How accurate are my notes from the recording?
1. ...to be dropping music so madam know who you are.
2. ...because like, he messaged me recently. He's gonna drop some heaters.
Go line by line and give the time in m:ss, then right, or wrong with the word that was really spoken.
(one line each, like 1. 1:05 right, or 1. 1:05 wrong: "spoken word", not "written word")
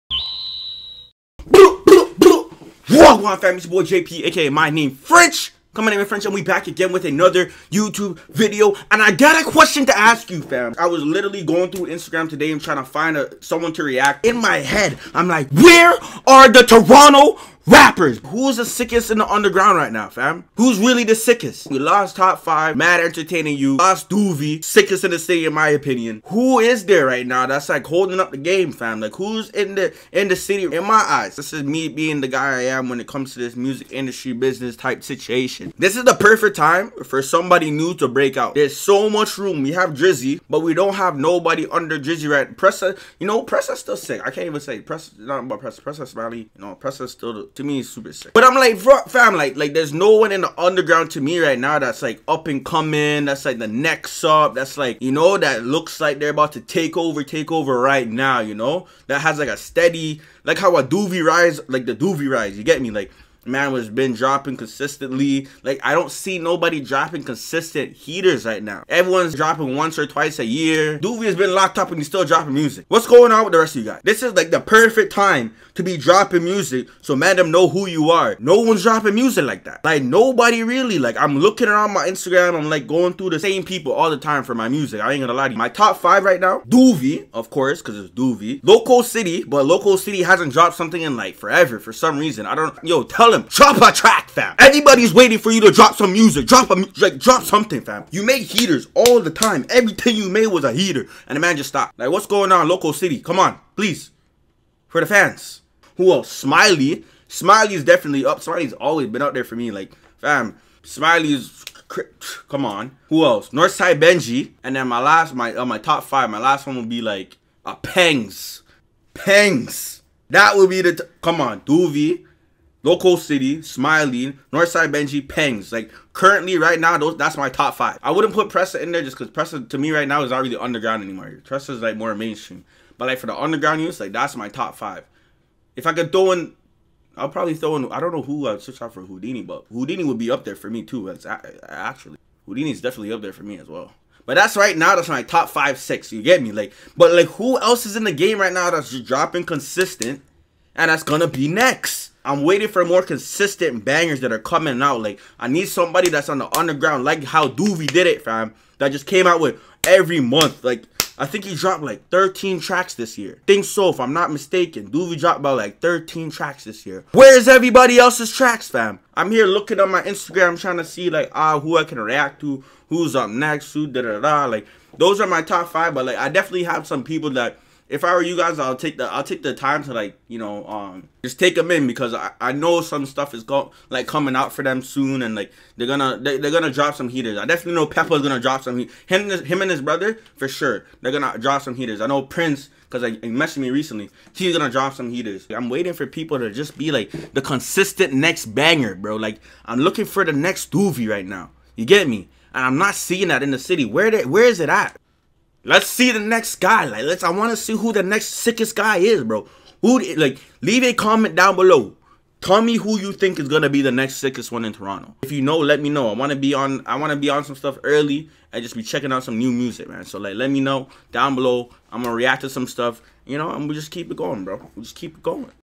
1. 1:15 right
2. 3:12 right.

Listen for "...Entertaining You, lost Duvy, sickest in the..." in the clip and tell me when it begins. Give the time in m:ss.
0:23.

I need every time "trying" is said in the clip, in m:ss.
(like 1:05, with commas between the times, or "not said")
0:12, 2:50.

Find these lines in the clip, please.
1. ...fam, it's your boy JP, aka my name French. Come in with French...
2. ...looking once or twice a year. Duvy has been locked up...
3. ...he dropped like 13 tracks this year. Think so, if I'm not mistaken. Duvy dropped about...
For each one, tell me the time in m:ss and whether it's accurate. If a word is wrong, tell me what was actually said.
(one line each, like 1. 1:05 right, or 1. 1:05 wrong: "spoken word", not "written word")
1. 0:03 right
2. 1:09 wrong: "dropping", not "looking"
3. 2:41 right.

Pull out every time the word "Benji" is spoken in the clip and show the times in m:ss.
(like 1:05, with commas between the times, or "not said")
1:54, 2:04.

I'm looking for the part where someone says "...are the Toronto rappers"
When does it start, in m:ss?
0:16.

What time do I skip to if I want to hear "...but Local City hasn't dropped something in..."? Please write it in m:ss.
1:29.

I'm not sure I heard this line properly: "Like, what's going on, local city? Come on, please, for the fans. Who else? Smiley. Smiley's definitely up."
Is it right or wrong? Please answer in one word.
right.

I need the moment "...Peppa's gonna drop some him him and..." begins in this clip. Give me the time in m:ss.
3:07.